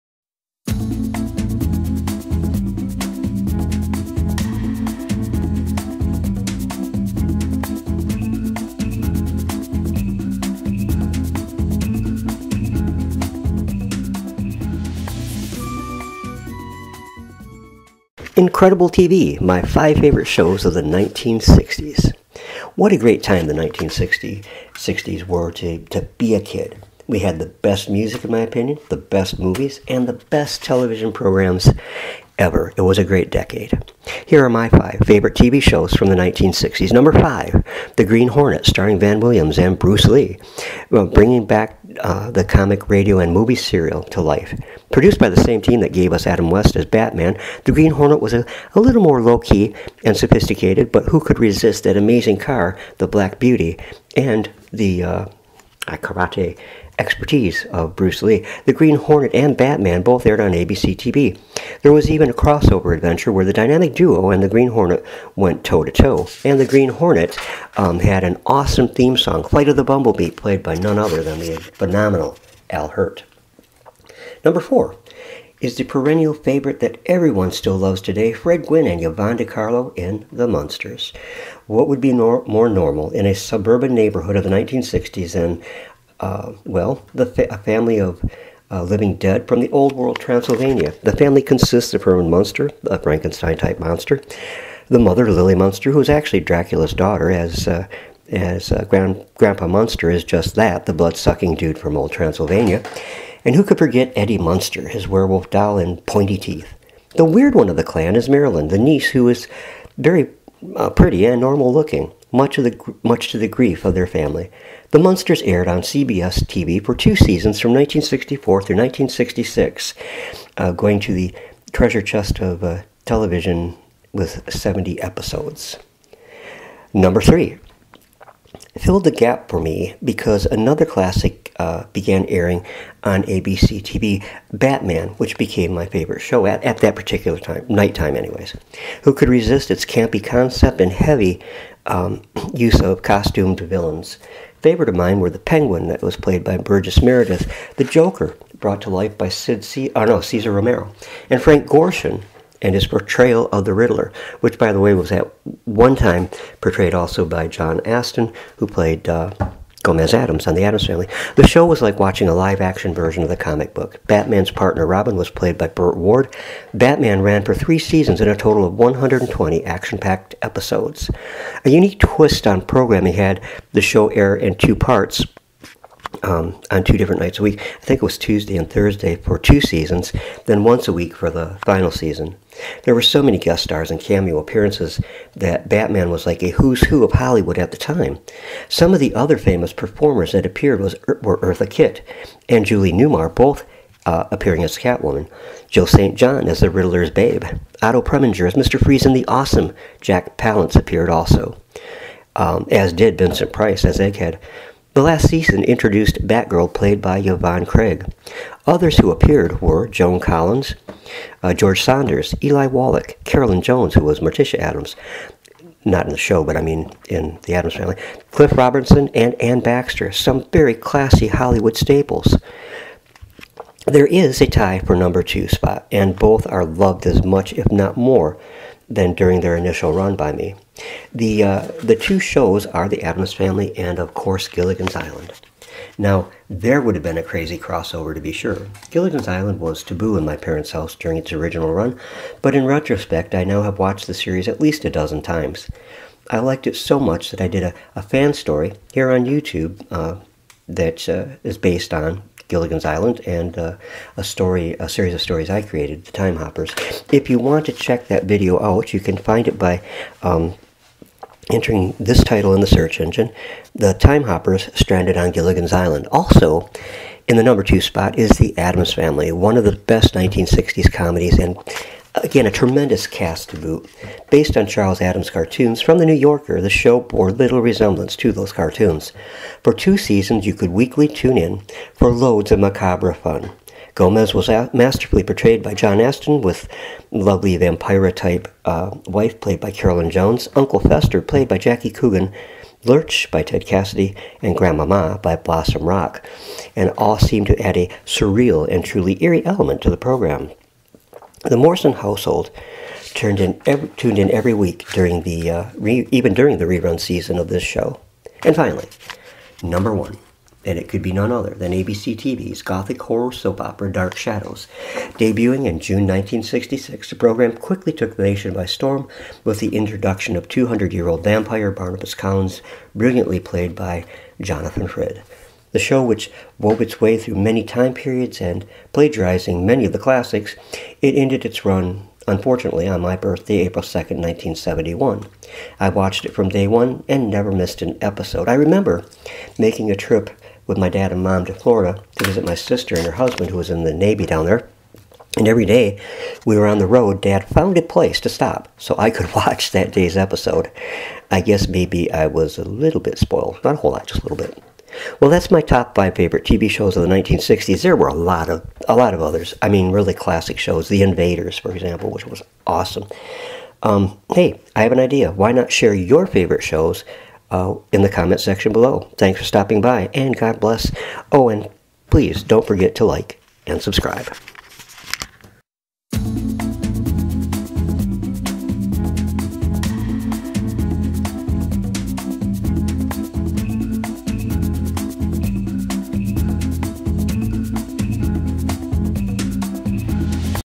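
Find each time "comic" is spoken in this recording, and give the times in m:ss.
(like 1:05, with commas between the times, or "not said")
0:42, 2:43.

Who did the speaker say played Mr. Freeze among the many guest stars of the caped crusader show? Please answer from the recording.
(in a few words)
Otto Preminger.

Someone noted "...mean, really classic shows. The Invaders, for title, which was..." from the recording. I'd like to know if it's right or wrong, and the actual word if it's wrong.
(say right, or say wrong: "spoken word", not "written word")
wrong: "example", not "title".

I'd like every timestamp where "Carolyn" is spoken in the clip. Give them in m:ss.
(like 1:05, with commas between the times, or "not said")
3:33, 4:49.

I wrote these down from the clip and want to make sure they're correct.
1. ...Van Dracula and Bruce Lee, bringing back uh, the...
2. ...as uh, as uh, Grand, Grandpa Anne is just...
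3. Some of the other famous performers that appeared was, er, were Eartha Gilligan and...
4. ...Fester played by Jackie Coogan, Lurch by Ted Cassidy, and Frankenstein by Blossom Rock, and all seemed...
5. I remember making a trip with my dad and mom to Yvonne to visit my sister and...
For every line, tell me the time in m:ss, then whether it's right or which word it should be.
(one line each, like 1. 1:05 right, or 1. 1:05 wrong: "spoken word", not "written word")
1. 0:38 wrong: "Williams", not "Dracula"
2. 1:37 wrong: "Munster", not "Anne"
3. 3:08 wrong: "Kitt", not "Gilligan"
4. 4:50 wrong: "Grandmama", not "Frankenstein"
5. 5:38 wrong: "Florida", not "Yvonne".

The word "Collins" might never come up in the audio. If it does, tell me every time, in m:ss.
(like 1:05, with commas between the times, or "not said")
3:30, 5:22.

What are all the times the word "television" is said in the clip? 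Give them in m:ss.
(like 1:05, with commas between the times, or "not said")
0:30, 2:03.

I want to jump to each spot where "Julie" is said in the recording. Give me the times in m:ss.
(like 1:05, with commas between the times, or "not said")
3:12.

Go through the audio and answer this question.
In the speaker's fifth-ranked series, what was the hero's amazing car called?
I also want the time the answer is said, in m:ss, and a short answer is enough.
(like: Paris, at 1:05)
Black Beauty, at 0:52.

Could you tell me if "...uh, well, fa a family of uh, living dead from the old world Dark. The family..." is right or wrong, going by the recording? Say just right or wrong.
wrong.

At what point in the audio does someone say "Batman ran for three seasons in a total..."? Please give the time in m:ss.
2:46.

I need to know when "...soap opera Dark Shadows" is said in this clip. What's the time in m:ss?
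5:13.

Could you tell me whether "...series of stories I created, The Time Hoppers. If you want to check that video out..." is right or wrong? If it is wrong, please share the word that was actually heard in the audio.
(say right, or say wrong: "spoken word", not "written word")
right.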